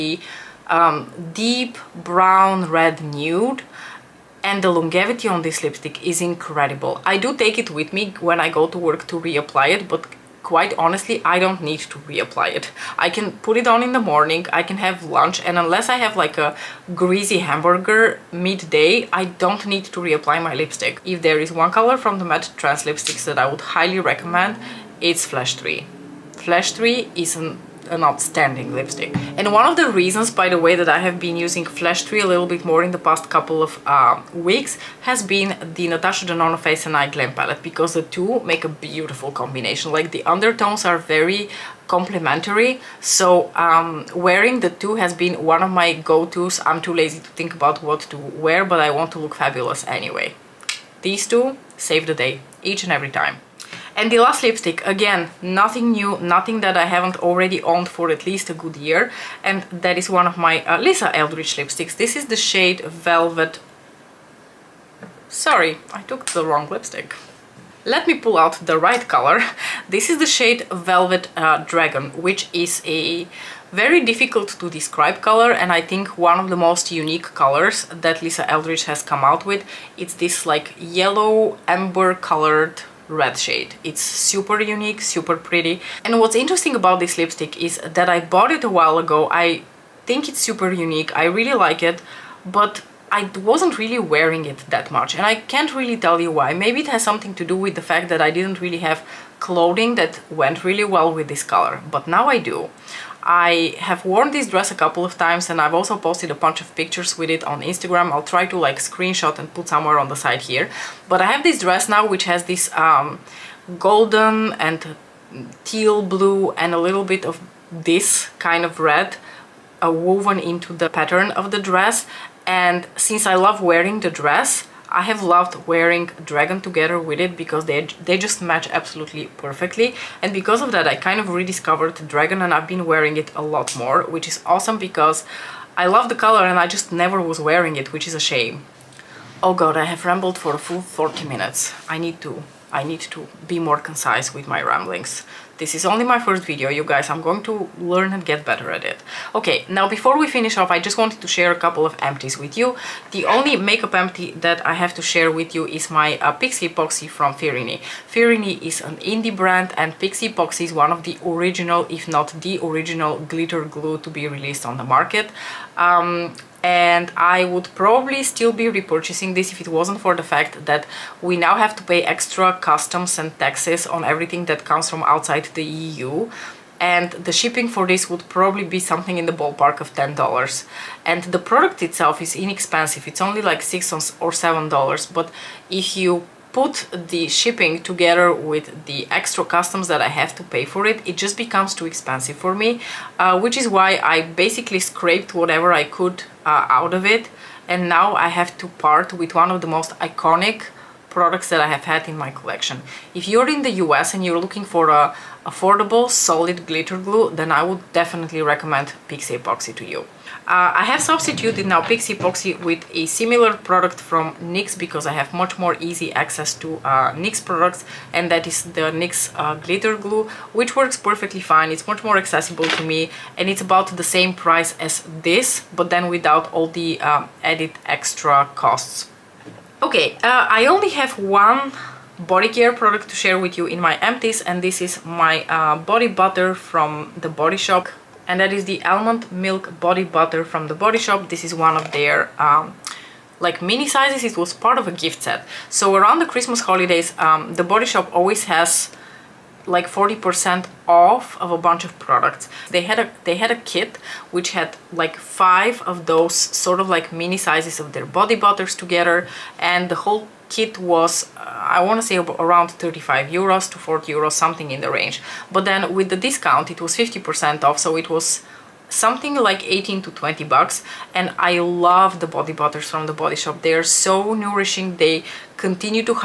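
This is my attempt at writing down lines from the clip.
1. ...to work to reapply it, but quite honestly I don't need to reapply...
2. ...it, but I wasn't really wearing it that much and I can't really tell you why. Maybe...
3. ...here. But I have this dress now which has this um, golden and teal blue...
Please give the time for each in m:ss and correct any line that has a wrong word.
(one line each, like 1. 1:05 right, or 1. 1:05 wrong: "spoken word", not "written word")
1. 0:08 right
2. 1:31 right
3. 1:50 right.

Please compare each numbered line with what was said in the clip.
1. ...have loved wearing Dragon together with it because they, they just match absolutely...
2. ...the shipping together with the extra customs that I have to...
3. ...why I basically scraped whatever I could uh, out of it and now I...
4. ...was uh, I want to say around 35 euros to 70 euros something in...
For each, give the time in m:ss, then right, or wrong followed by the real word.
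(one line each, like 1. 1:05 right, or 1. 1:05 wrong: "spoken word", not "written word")
1. 2:05 right
2. 3:06 right
3. 3:13 right
4. 4:20 wrong: "40", not "70".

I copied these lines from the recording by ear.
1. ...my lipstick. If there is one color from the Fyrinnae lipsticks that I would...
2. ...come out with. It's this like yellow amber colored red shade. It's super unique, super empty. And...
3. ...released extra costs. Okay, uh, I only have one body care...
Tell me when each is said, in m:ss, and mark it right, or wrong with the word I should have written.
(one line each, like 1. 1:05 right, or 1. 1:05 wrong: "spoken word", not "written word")
1. 0:20 wrong: "MatteTrance", not "Fyrinnae"
2. 1:19 wrong: "pretty", not "empty"
3. 3:47 wrong: "added", not "released".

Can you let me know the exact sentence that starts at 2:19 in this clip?
Oh god I have rambled for a full 40 minutes.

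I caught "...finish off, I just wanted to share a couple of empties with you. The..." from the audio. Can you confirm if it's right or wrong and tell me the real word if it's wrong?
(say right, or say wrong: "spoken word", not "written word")
right.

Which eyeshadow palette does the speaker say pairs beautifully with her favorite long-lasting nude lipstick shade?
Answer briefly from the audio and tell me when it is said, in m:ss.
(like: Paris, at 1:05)
Natasha Denona Face and Eye Glam Palette, at 0:35.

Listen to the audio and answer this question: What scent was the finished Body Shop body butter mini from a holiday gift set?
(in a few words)
almond milk.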